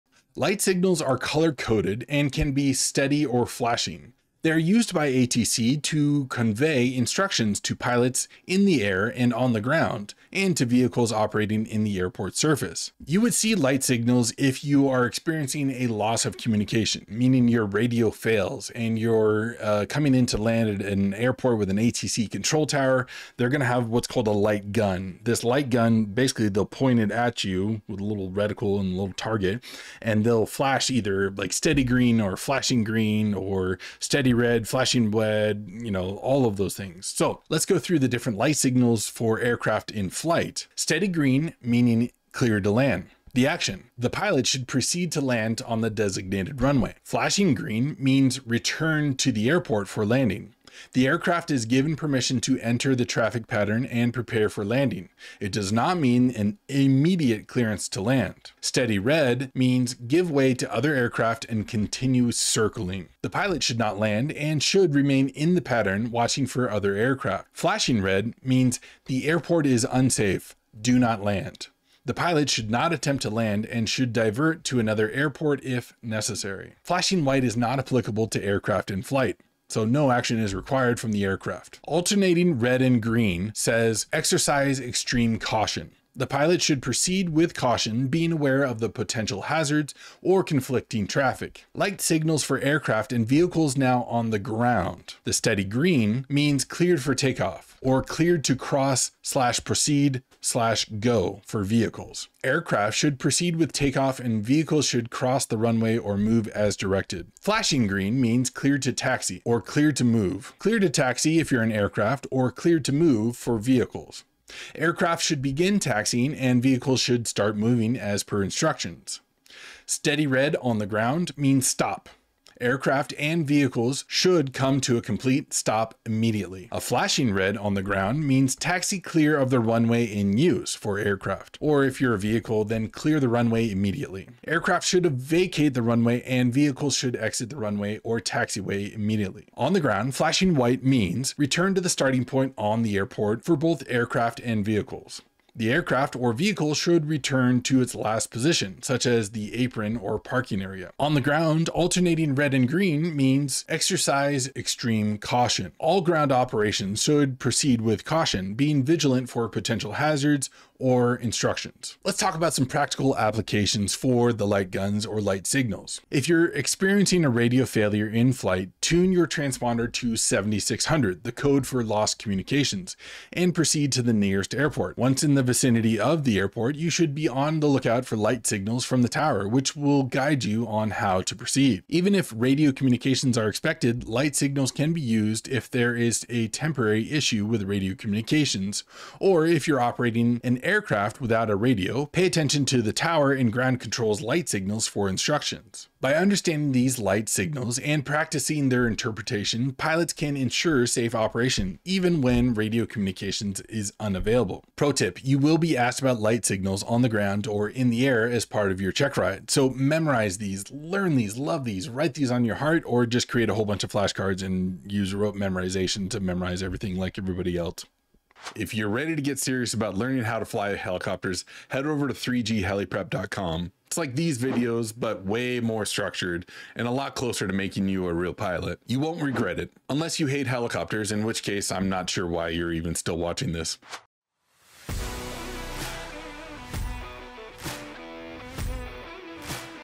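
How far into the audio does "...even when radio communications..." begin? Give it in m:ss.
3:21.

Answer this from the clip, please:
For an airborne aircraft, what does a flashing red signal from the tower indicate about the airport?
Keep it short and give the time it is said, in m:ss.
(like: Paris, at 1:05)
airport is unsafe, at 1:09.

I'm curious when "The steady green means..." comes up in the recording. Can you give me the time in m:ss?
1:35.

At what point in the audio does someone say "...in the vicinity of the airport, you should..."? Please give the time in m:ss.
2:55.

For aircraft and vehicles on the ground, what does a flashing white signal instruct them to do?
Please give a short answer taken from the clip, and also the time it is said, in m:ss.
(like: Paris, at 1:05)
return to the starting point, at 2:21.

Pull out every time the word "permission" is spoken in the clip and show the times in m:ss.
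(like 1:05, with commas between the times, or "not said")
0:51.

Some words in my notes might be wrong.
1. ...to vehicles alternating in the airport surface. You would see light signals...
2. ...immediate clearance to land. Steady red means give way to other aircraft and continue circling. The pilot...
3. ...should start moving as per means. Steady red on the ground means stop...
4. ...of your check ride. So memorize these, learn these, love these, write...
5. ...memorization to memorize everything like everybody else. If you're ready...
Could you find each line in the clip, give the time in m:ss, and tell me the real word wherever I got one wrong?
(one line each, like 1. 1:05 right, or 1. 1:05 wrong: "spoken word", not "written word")
1. 0:10 wrong: "operating", not "alternating"
2. 0:56 right
3. 1:56 wrong: "instructions", not "means"
4. 3:28 right
5. 3:35 right.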